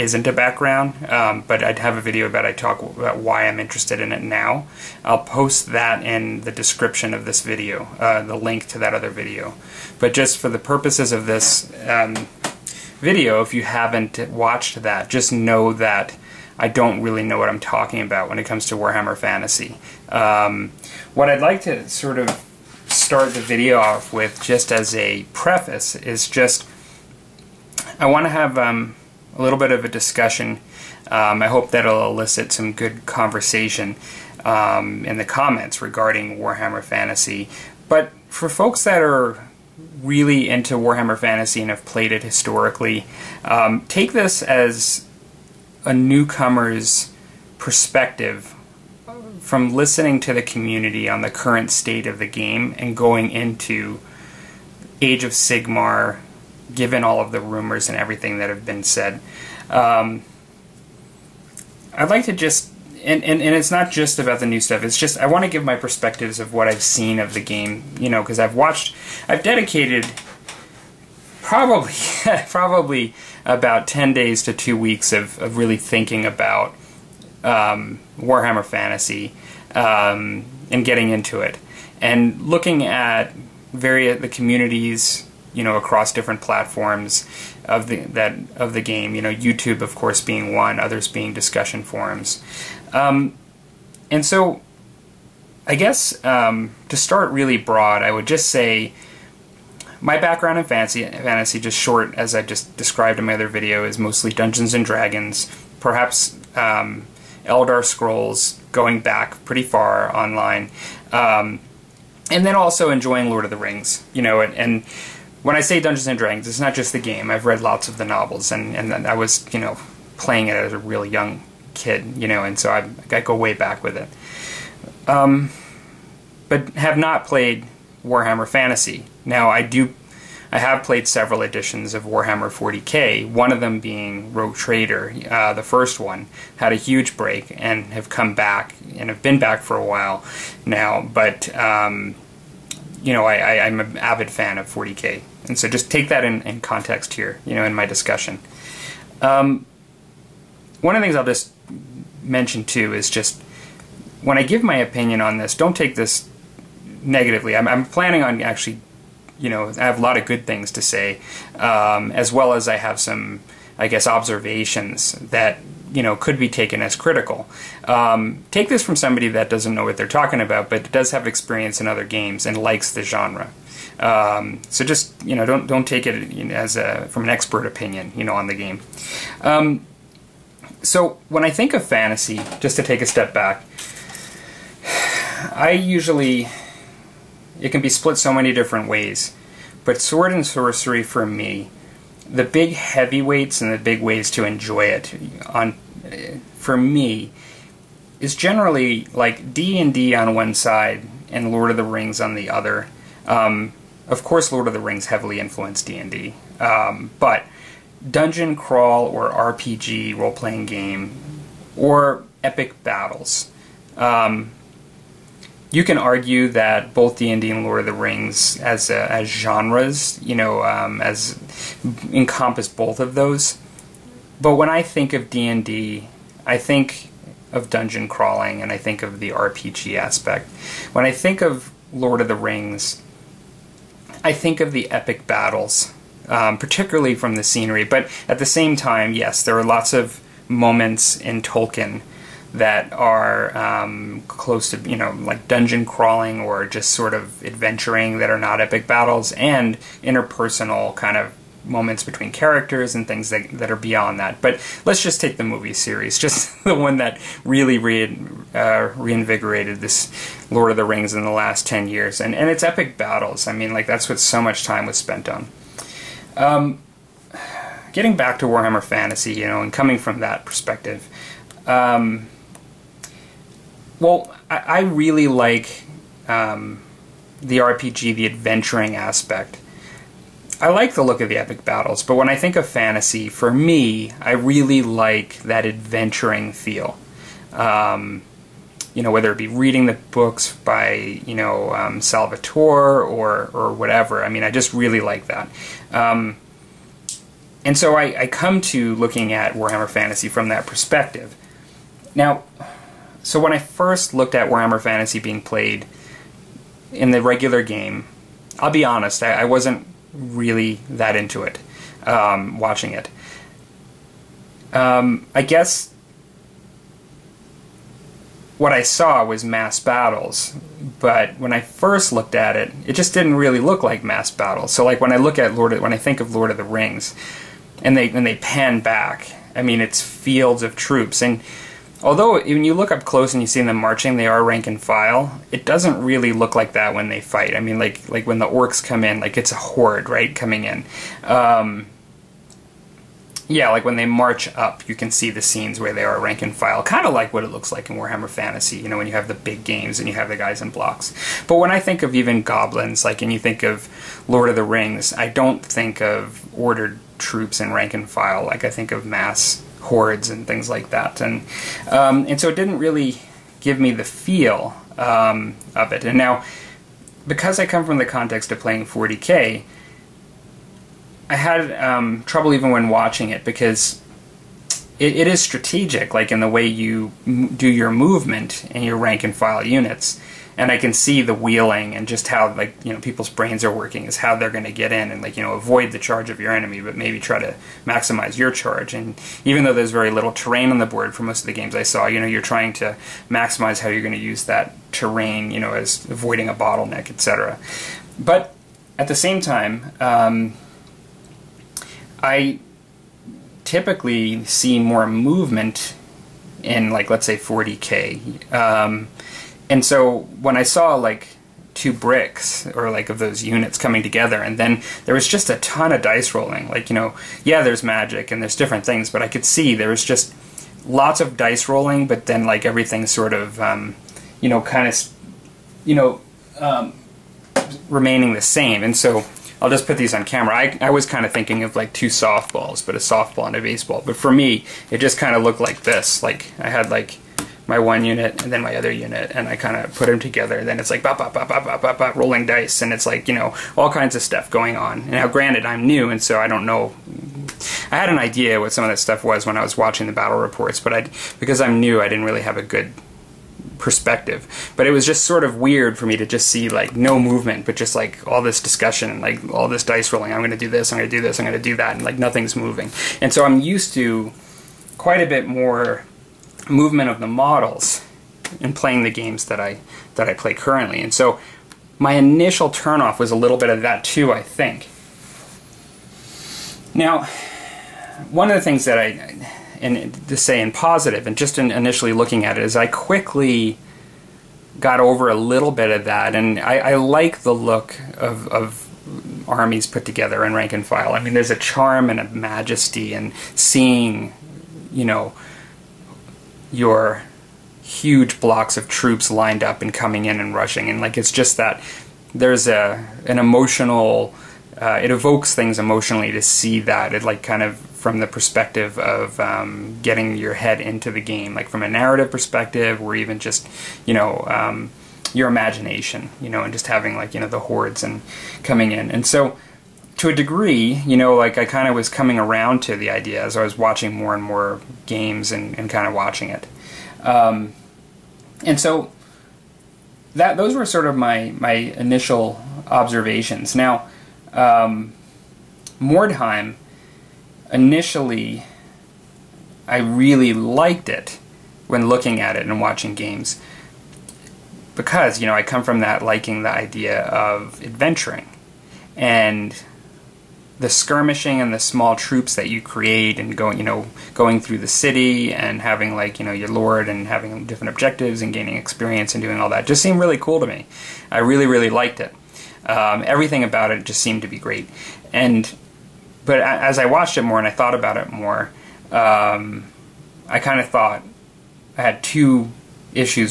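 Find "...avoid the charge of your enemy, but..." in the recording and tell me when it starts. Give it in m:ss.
6:25.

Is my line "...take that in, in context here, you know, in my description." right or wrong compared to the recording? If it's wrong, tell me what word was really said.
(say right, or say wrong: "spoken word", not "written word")
wrong: "discussion", not "description".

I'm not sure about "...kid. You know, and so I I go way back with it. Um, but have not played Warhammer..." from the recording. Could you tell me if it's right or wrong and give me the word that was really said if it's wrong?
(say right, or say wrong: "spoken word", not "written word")
right.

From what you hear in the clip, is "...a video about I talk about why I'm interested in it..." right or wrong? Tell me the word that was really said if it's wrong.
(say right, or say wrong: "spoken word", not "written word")
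right.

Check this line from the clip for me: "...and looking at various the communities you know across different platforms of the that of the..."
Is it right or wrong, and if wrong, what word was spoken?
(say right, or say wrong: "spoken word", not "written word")
right.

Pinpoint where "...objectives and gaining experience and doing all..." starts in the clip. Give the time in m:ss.
9:17.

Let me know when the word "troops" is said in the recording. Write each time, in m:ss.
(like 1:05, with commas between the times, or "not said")
5:30, 5:57, 8:18, 9:12.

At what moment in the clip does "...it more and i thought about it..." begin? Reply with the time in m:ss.
9:27.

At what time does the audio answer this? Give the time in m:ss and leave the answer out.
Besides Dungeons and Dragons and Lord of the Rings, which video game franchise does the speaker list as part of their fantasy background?
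1:47.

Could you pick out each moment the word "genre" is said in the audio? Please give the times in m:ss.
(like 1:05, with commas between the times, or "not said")
2:53, 3:39.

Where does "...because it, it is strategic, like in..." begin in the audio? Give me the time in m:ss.
6:13.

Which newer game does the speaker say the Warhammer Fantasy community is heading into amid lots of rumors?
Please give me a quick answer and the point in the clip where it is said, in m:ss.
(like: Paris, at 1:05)
Age of Sigmar, at 0:55.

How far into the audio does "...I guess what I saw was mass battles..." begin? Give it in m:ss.
5:15.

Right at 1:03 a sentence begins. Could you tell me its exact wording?
And, and, and it's not just about the new stuff.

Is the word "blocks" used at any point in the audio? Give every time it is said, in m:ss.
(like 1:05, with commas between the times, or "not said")
5:50, 8:18.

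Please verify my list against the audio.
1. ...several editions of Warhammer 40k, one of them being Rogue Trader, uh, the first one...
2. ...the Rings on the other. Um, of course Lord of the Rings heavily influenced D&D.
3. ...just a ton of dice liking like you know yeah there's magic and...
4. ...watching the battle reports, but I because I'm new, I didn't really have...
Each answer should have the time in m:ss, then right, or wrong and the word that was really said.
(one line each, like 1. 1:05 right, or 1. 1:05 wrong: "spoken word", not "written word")
1. 2:11 right
2. 3:21 right
3. 6:55 wrong: "rolling", not "liking"
4. 7:29 right.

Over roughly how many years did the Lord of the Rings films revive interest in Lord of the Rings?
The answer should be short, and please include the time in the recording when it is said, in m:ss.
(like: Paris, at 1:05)
10, at 4:21.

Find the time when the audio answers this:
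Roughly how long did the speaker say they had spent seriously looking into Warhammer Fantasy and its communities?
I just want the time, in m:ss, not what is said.
1:13.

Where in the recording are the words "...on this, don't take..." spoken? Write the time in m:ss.
2:35.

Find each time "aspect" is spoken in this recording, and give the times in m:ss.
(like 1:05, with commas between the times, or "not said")
3:49, 4:38.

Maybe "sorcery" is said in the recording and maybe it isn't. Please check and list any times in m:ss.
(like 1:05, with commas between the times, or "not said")
3:10.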